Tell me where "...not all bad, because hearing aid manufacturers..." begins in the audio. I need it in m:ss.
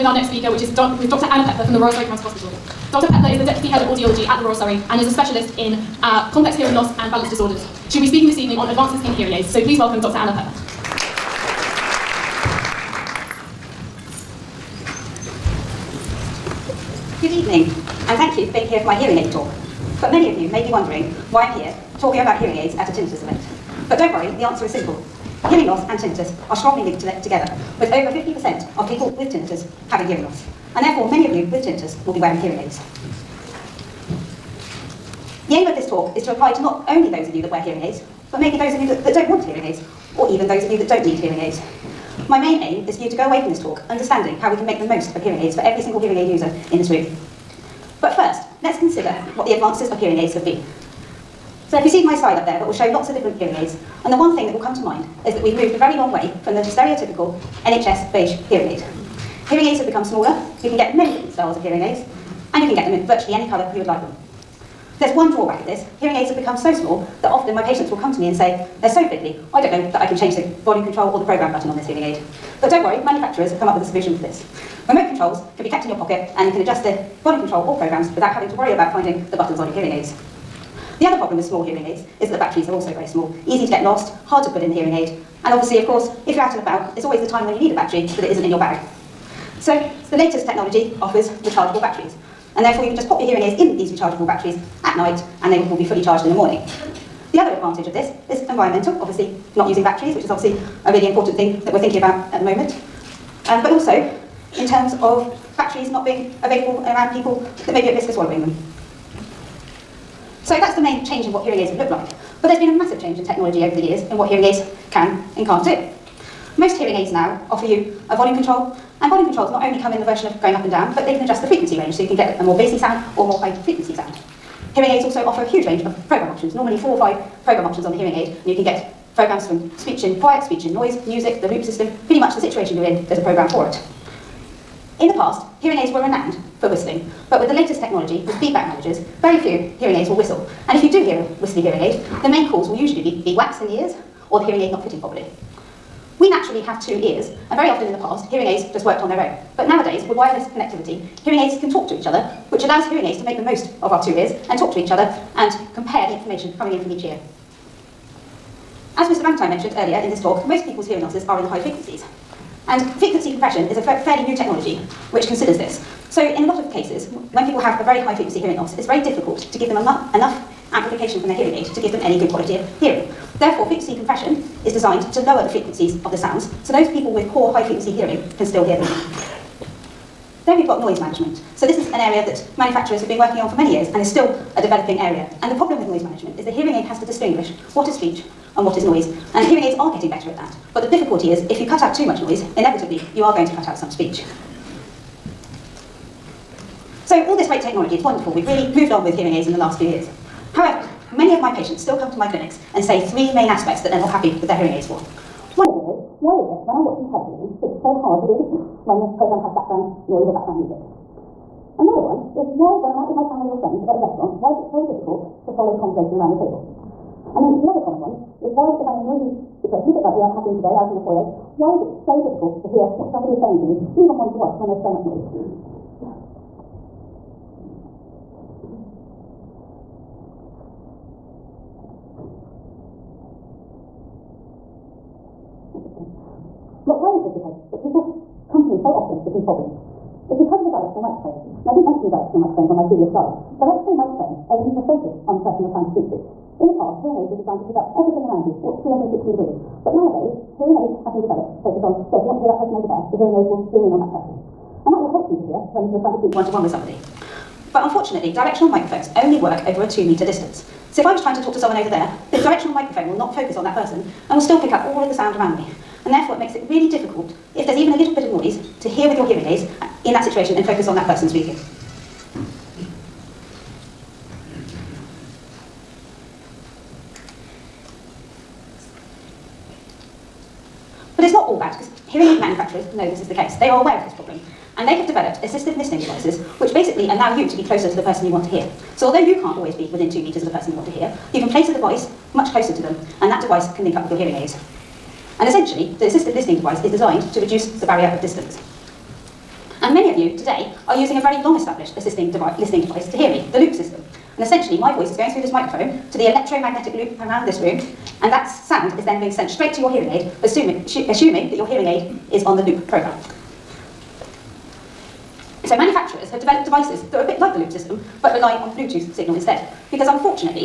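4:41.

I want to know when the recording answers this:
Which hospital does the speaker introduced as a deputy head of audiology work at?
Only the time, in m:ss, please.
0:01.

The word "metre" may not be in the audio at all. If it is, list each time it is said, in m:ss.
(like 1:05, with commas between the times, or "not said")
4:20.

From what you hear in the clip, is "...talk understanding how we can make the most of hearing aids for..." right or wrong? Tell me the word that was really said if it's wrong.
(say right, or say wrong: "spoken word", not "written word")
right.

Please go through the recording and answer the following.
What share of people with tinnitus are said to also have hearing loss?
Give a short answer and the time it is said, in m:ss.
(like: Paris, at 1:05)
over 50%, at 0:27.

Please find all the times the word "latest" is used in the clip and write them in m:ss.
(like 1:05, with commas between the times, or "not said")
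1:30, 2:17.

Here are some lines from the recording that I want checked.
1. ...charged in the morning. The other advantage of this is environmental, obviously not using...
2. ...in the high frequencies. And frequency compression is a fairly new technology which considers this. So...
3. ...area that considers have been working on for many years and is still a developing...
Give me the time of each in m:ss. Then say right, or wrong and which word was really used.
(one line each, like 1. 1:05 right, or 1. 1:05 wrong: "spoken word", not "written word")
1. 1:36 right
2. 2:41 right
3. 3:01 wrong: "manufacturers", not "considers".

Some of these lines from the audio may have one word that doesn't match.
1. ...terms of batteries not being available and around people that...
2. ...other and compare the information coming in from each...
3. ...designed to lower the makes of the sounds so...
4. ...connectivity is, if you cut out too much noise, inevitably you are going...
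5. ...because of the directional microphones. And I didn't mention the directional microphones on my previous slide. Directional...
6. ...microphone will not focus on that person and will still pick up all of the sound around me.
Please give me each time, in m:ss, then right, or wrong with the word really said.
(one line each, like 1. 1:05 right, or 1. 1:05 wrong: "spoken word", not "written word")
1. 1:44 right
2. 2:34 right
3. 2:54 wrong: "frequencies", not "makes"
4. 3:10 wrong: "difficulty", not "connectivity"
5. 4:00 right
6. 4:22 right.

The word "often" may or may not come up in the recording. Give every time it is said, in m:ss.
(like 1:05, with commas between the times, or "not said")
1:07, 2:27, 3:58.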